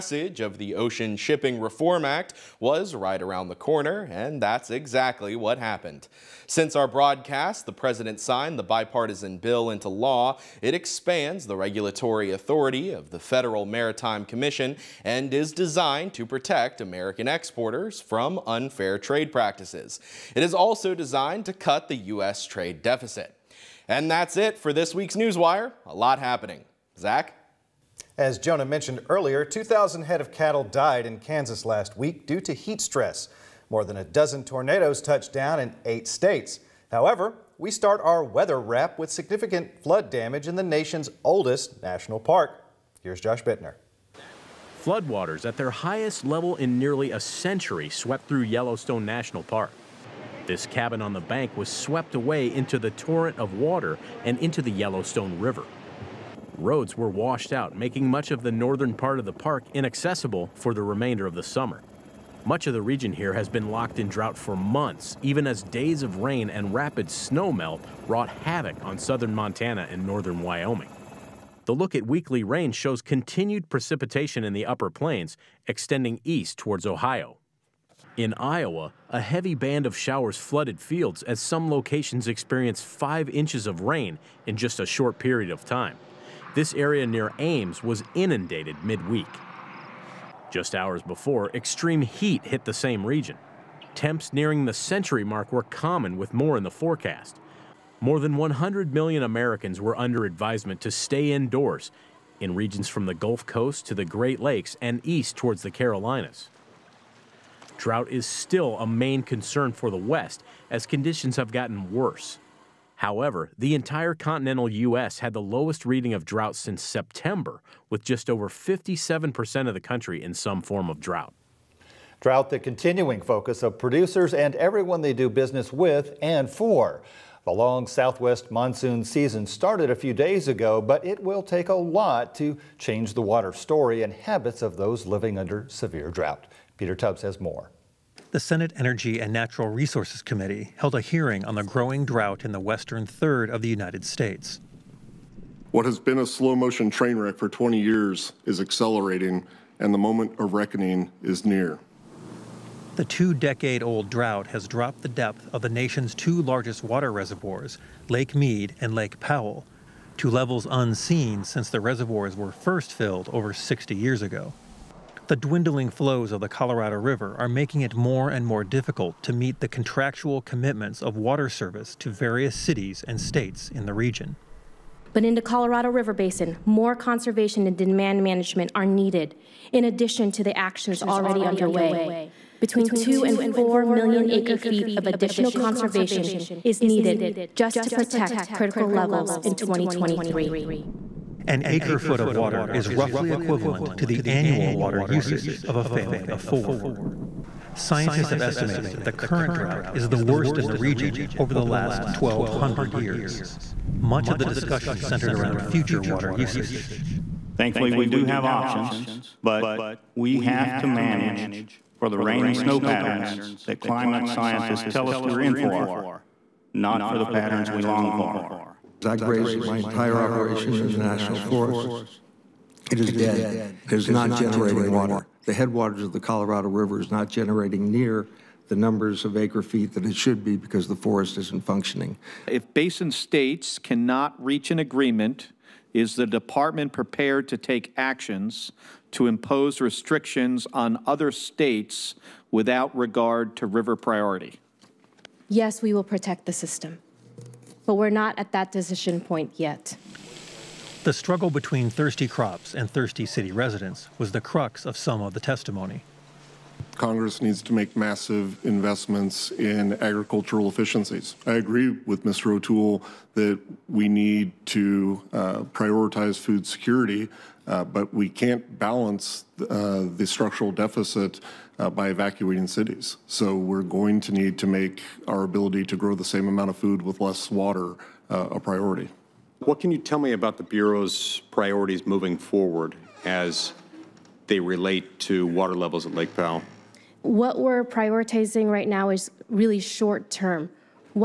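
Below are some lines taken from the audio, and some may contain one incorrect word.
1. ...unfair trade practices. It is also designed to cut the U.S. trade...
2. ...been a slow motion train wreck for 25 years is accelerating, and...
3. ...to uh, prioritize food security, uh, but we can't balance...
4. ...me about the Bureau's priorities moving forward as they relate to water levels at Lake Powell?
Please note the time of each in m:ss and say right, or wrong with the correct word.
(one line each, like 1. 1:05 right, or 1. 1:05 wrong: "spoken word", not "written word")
1. 0:18 right
2. 2:25 wrong: "20", not "25"
3. 4:24 right
4. 4:40 right.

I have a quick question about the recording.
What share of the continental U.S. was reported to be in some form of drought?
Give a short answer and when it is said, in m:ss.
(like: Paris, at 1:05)
just over 57%, at 1:58.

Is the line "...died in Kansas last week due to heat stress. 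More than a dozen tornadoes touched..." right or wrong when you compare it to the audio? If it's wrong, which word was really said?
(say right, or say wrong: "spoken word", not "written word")
right.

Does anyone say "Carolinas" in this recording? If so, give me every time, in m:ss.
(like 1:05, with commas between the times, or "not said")
1:45.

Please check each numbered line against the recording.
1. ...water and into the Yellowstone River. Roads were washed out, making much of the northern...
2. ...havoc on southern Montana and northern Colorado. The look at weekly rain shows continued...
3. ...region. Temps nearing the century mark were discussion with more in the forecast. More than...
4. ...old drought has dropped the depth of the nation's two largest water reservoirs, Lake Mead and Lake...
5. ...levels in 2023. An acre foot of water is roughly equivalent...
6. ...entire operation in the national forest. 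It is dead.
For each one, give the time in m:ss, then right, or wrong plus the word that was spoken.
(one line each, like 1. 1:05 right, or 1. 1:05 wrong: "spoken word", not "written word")
1. 0:53 right
2. 1:08 wrong: "Wyoming", not "Colorado"
3. 1:33 wrong: "common", not "discussion"
4. 2:33 right
5. 3:08 right
6. 3:39 right.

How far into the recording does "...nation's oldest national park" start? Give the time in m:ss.
0:40.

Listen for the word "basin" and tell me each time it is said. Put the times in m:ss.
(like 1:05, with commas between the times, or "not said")
2:56, 3:52.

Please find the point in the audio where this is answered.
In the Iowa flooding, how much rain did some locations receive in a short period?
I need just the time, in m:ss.
1:22.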